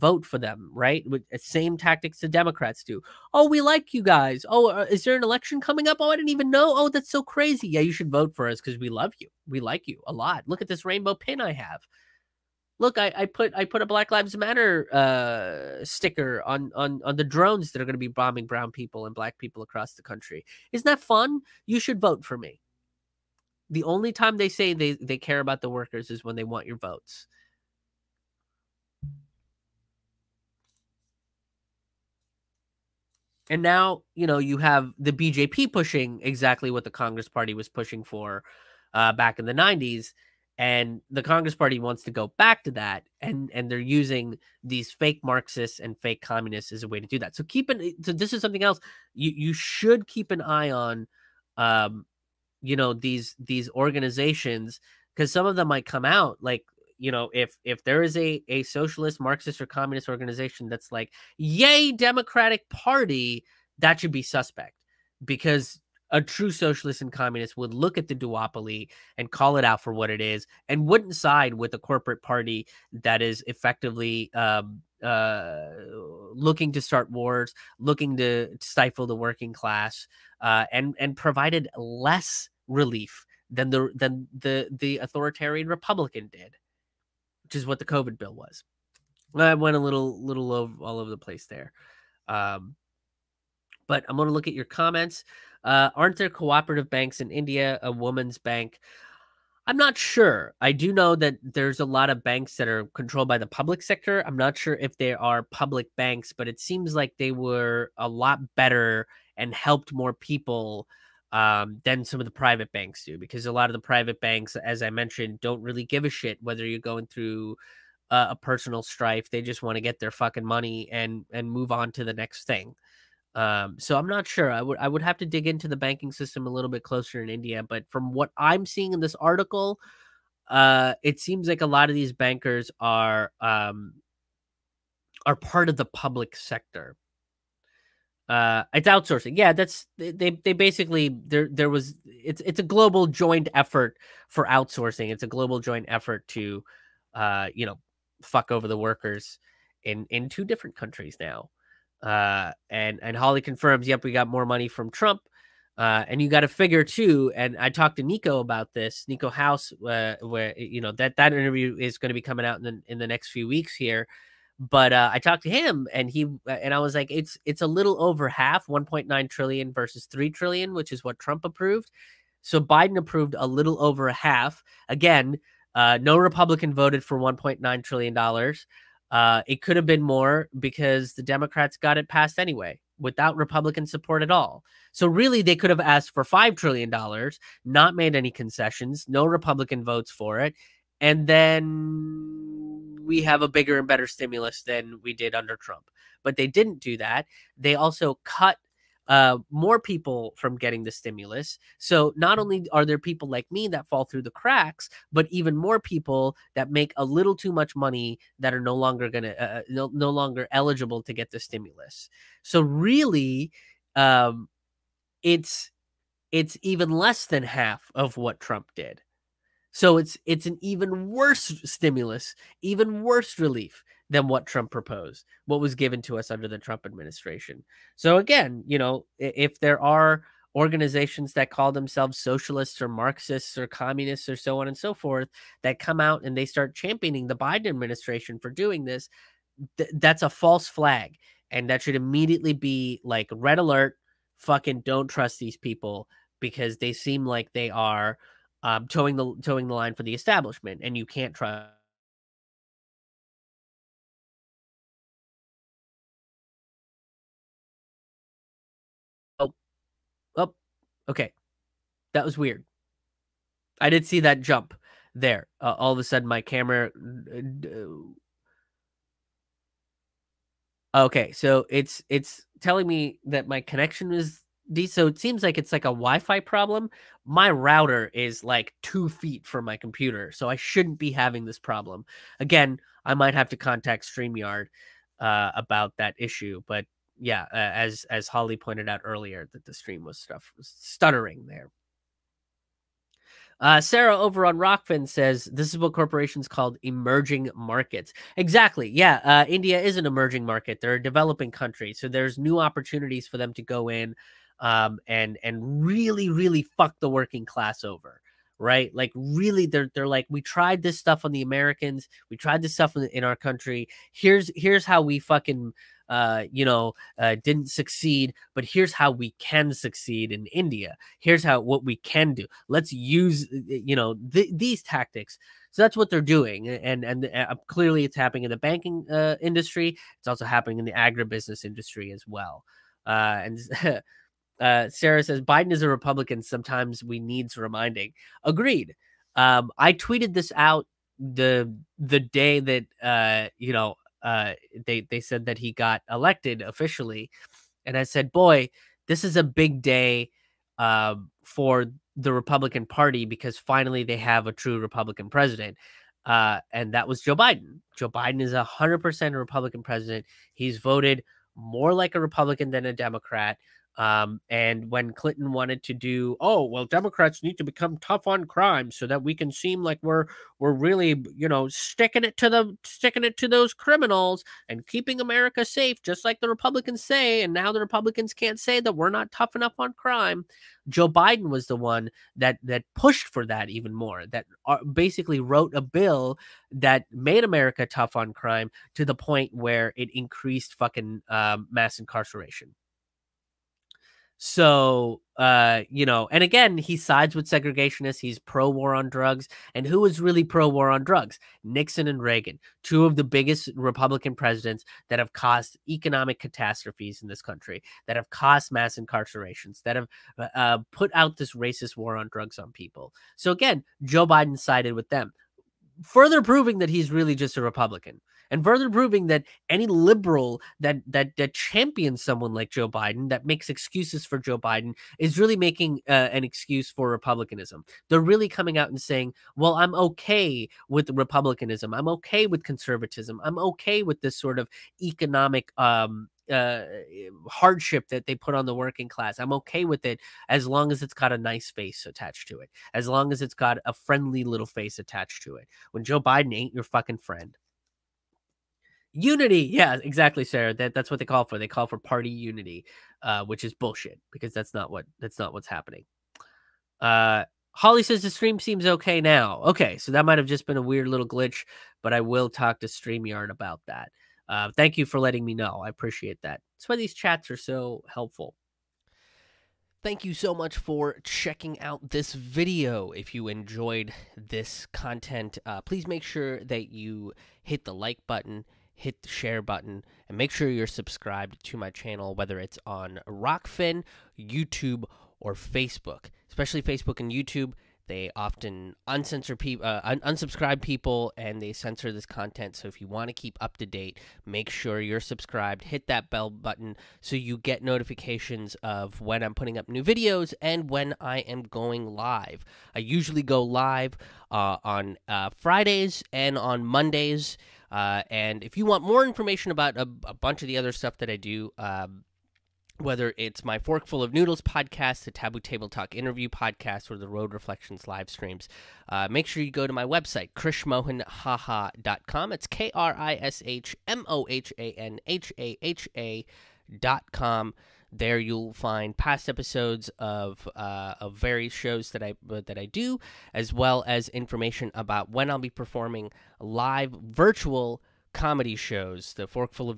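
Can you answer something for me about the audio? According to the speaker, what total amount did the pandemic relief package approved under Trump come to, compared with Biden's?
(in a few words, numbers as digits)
3 trillion.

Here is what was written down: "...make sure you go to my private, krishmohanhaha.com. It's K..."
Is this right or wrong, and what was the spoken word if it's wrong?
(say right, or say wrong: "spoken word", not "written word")
wrong: "website", not "private".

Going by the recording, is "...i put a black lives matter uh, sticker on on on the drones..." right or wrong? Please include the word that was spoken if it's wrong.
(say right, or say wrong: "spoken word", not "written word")
right.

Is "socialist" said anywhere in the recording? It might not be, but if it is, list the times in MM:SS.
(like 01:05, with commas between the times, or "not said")
00:58, 01:06, 03:52.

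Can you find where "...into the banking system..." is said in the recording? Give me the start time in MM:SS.
02:05.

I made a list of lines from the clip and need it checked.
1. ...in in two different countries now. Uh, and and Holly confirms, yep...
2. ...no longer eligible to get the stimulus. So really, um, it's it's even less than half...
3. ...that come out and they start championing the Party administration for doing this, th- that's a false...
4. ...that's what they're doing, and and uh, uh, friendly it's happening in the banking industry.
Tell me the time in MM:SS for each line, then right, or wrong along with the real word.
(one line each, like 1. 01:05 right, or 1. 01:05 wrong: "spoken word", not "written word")
1. 02:29 right
2. 03:29 right
3. 03:55 wrong: "Biden", not "Party"
4. 05:25 wrong: "clearly", not "friendly".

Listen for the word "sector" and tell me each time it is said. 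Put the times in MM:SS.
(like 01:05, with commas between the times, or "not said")
01:43, 02:16.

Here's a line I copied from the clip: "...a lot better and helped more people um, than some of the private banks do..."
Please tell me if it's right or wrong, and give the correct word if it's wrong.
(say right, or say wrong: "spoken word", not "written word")
right.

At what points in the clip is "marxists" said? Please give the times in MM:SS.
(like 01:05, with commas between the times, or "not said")
00:45, 00:59, 03:52.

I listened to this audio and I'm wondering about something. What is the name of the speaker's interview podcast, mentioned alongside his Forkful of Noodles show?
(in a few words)
Taboo Table Talk.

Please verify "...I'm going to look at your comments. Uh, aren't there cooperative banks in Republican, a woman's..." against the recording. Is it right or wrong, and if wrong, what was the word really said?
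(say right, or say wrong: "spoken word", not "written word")
wrong: "India", not "Republican".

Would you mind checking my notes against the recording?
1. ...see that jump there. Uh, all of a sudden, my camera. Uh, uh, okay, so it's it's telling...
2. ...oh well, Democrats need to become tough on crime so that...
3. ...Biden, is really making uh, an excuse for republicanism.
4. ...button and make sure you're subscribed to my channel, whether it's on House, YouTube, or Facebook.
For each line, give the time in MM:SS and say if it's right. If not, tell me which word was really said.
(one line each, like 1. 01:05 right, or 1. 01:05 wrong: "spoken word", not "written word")
1. 04:24 right
2. 06:06 right
3. 07:04 right
4. 07:59 wrong: "Rokfin", not "House".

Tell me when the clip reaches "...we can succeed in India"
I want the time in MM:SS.
05:19.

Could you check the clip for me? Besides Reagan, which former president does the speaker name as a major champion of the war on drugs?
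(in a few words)
Nixon.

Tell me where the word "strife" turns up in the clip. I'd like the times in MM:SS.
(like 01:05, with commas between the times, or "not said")
01:58.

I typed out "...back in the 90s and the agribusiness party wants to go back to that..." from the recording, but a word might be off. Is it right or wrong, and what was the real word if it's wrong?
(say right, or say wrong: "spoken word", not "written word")
wrong: "congress", not "agribusiness".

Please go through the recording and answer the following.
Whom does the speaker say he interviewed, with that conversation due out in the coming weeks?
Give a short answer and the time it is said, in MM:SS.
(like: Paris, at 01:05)
Nico House, at 02:39.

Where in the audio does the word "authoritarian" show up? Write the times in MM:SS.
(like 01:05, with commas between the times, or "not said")
01:24.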